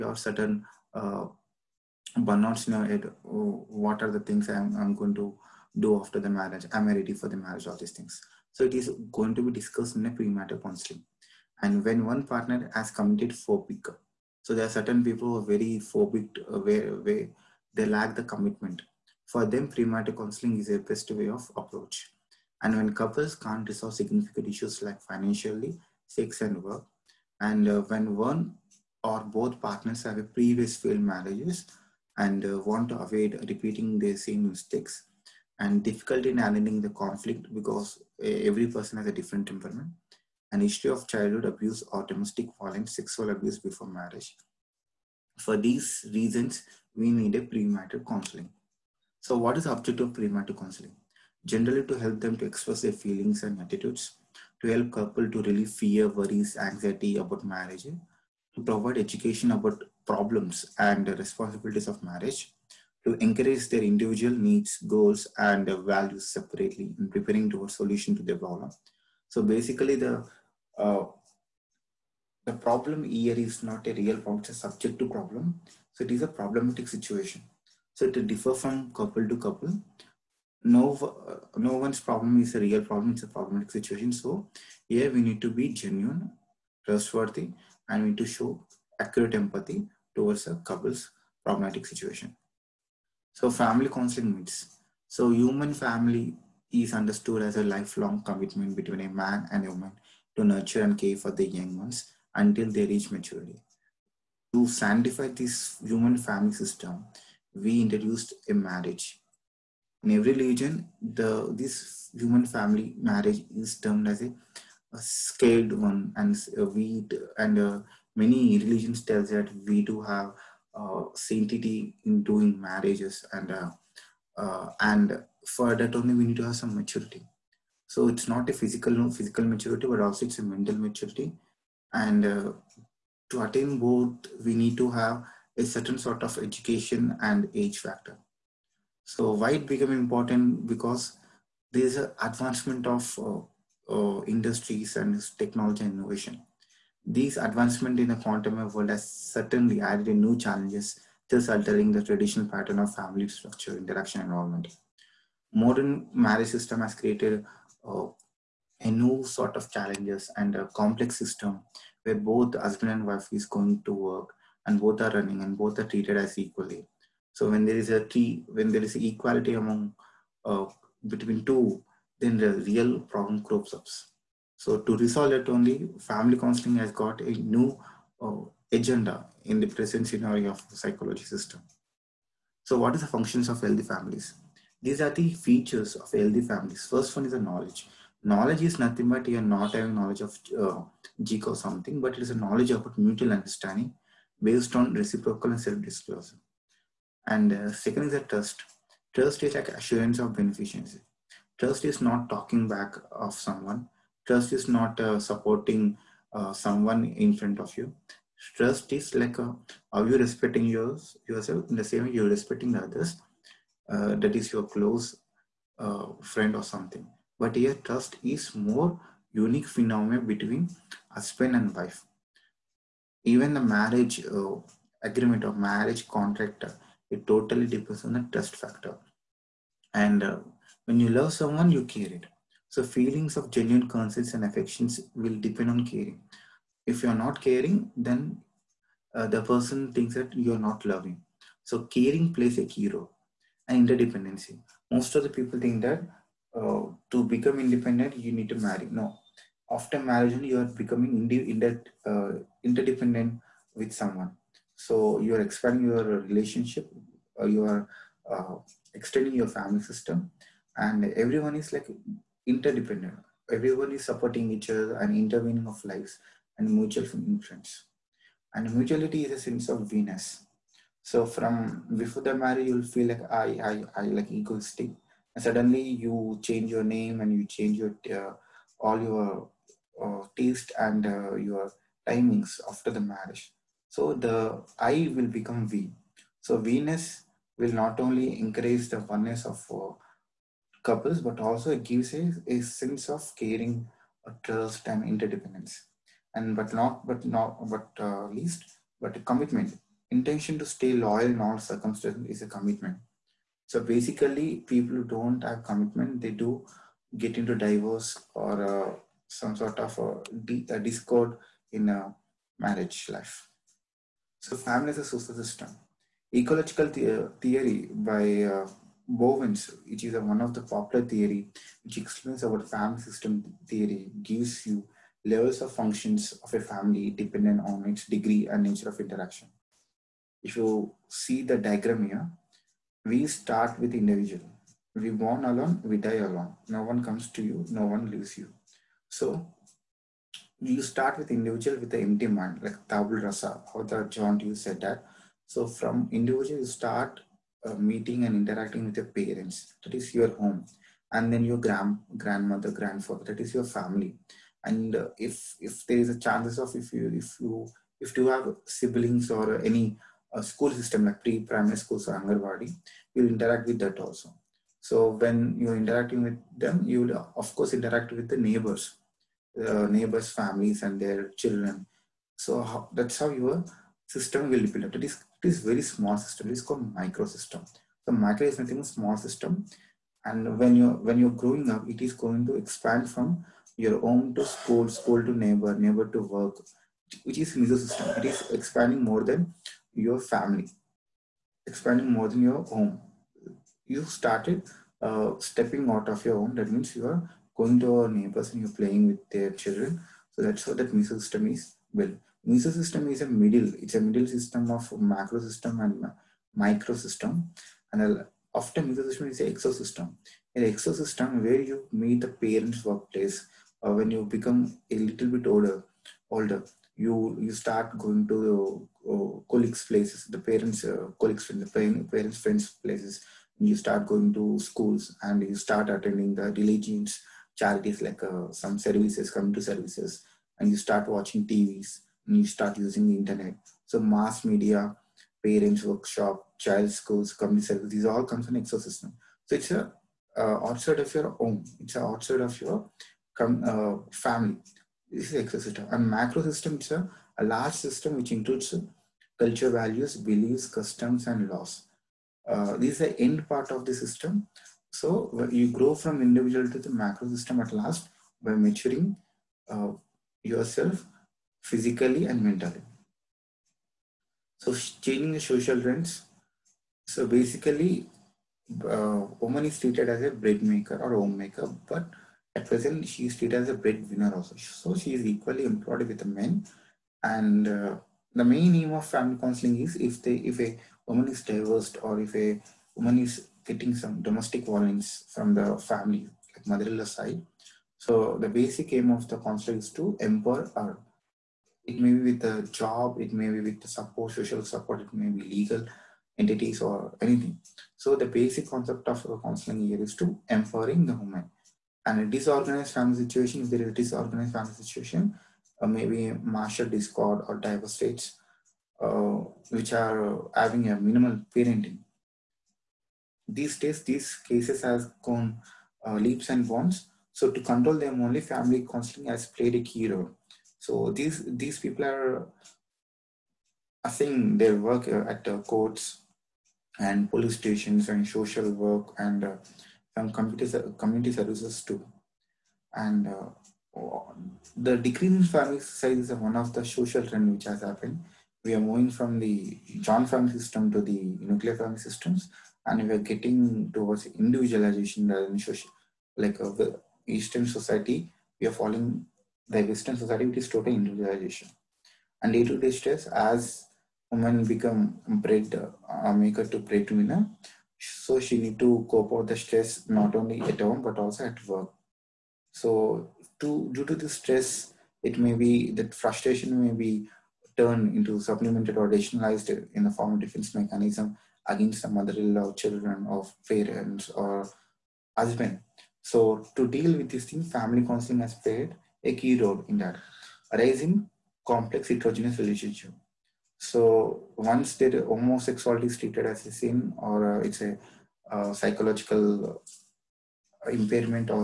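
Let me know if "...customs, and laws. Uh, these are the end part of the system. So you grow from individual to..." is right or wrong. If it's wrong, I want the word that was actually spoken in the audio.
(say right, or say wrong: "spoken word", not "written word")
right.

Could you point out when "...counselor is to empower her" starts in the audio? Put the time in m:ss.
8:09.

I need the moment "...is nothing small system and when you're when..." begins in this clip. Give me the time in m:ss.
6:18.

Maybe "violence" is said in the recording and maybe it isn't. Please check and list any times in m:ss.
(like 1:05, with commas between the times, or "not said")
0:42, 8:04.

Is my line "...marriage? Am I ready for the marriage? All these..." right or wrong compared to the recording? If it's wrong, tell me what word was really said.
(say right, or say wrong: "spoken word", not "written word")
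right.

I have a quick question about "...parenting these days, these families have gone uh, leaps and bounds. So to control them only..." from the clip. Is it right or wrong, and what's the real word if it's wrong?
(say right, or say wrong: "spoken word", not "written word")
wrong: "cases", not "families".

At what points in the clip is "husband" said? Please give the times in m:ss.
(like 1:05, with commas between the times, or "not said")
2:42, 3:41, 9:35.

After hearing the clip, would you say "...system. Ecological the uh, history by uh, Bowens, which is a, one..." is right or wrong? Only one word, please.
wrong.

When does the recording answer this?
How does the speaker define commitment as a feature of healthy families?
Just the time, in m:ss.
5:00.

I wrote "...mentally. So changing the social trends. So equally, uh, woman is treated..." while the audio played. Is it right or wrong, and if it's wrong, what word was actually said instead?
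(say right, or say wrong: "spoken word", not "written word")
wrong: "basically", not "equally".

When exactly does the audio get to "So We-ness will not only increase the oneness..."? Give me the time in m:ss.
4:46.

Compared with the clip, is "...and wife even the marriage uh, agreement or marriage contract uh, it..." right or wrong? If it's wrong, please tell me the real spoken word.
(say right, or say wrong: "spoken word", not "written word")
right.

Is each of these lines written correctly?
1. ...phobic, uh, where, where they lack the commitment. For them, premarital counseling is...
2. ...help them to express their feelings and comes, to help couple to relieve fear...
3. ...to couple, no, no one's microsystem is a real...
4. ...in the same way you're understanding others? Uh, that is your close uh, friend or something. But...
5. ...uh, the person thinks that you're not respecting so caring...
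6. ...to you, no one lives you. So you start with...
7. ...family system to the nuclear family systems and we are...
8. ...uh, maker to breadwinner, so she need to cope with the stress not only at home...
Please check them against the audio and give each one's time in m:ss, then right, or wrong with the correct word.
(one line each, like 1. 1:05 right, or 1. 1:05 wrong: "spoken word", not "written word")
1. 0:15 right
2. 0:51 wrong: "attitudes", not "comes"
3. 1:19 wrong: "problem", not "microsystem"
4. 3:31 wrong: "respecting", not "understanding"
5. 3:59 wrong: "loving", not "respecting"
6. 5:37 wrong: "leaves", not "lives"
7. 9:00 right
8. 9:16 right.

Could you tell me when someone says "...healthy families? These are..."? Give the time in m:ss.
3:03.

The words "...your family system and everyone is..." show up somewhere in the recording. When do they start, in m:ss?
4:19.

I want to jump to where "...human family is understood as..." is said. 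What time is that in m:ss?
1:35.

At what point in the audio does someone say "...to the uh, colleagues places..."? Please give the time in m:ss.
6:58.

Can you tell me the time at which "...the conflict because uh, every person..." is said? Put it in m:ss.
0:36.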